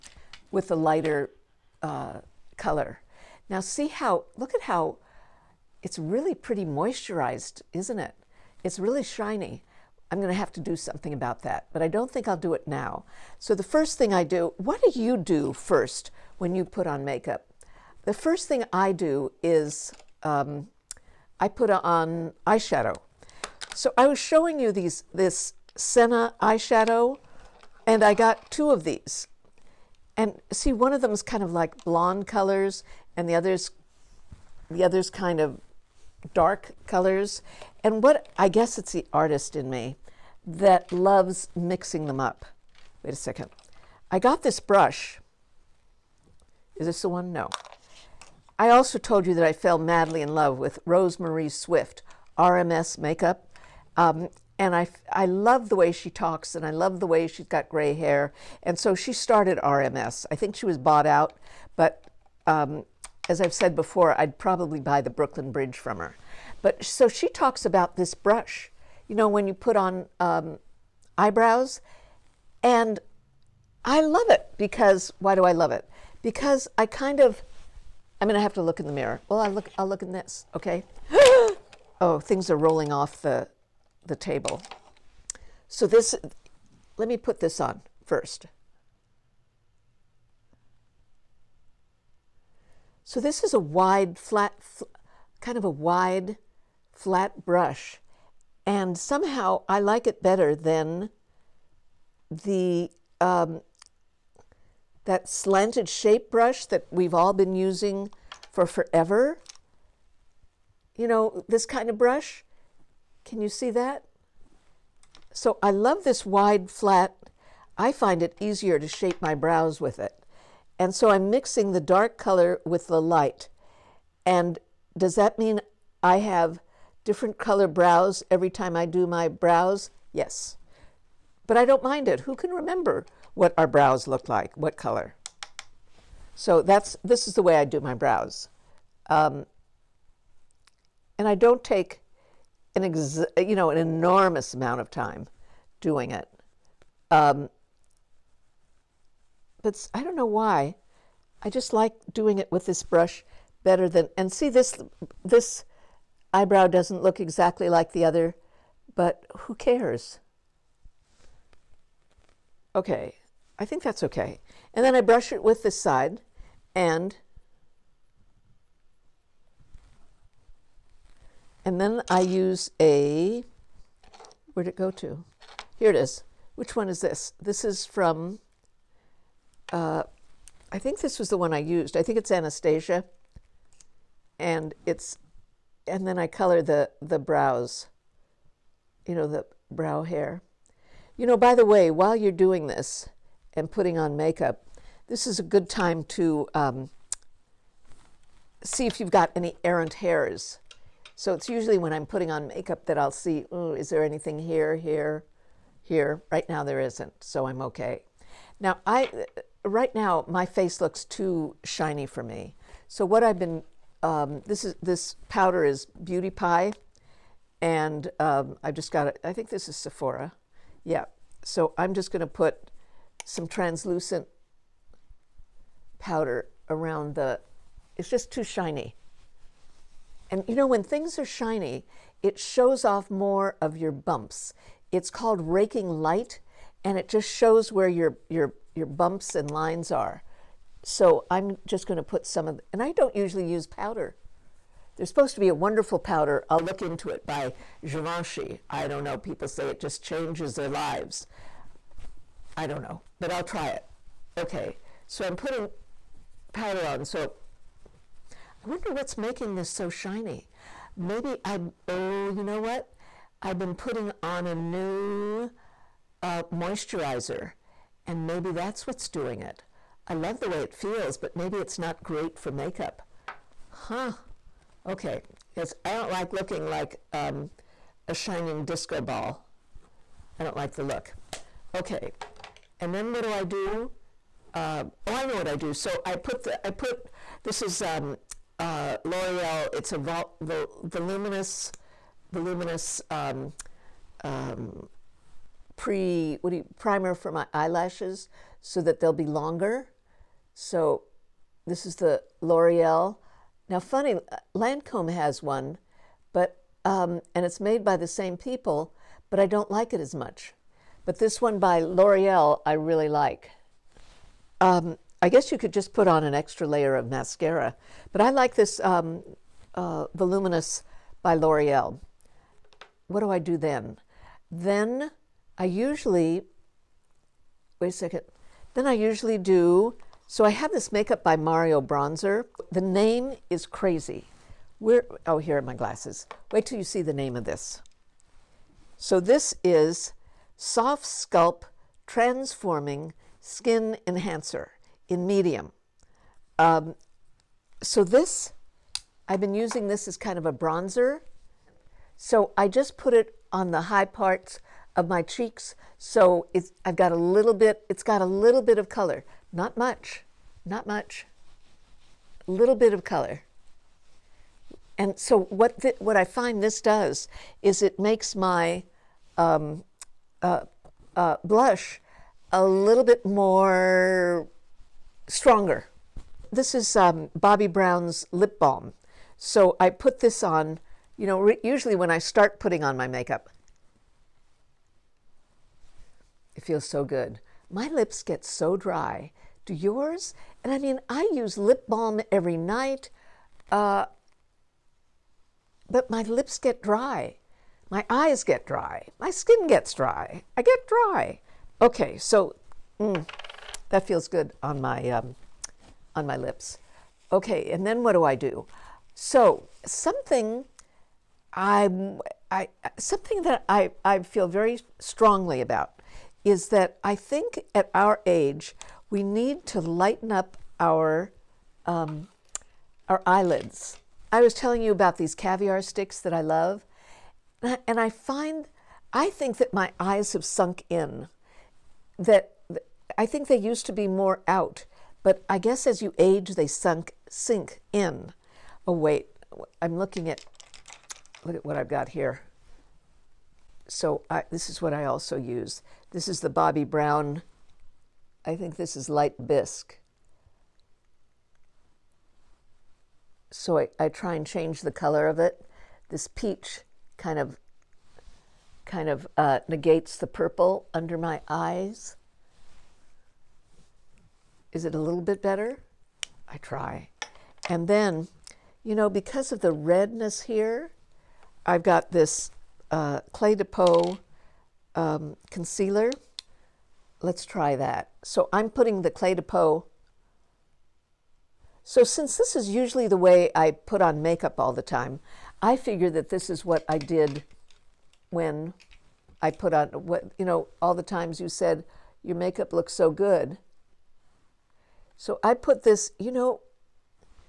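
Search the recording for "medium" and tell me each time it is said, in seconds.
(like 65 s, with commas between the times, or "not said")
345 s.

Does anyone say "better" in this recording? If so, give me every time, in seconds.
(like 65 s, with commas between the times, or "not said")
100 s, 153 s, 465 s.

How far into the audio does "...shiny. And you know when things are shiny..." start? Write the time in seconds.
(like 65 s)
228 s.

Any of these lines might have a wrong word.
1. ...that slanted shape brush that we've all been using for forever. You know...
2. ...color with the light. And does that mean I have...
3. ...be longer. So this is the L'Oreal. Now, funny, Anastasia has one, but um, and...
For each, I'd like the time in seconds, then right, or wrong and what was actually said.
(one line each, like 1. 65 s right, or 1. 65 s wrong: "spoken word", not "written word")
1. 105 s right
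2. 122 s right
3. 299 s wrong: "Lancome", not "Anastasia".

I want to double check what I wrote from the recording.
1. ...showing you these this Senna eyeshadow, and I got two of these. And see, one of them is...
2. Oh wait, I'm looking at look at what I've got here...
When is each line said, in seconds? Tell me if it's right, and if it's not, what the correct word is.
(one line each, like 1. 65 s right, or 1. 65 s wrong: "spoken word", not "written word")
1. 24 s right
2. 438 s right.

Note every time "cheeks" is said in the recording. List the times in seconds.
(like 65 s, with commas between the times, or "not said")
355 s.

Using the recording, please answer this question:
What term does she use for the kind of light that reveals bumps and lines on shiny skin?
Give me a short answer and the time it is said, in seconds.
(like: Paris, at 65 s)
raking light, at 235 s.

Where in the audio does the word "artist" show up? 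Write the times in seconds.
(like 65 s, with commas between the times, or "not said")
39 s.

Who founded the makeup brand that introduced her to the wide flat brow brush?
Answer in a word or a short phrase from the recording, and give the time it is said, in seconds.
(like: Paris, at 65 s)
Rosemarie Swift, at 50 s.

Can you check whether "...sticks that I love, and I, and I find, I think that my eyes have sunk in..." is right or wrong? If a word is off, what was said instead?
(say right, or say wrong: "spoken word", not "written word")
right.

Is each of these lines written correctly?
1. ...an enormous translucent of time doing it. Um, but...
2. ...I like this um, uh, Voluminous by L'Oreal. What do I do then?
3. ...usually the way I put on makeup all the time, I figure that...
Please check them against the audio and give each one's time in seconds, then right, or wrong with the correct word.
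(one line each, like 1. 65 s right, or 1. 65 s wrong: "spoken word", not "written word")
1. 143 s wrong: "amount", not "translucent"
2. 318 s right
3. 482 s right.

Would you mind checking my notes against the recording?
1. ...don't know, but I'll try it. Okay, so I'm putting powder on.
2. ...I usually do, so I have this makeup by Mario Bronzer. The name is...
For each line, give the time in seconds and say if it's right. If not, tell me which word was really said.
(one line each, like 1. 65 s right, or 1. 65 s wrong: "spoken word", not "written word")
1. 252 s right
2. 328 s right.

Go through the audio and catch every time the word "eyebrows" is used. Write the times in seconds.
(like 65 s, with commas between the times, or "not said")
71 s, 156 s.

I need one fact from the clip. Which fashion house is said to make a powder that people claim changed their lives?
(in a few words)
Givenchy.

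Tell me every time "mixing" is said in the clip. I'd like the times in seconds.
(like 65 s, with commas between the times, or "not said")
41 s, 121 s.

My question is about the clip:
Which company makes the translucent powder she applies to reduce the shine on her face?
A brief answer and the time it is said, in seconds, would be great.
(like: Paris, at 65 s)
Beauty Pie, at 216 s.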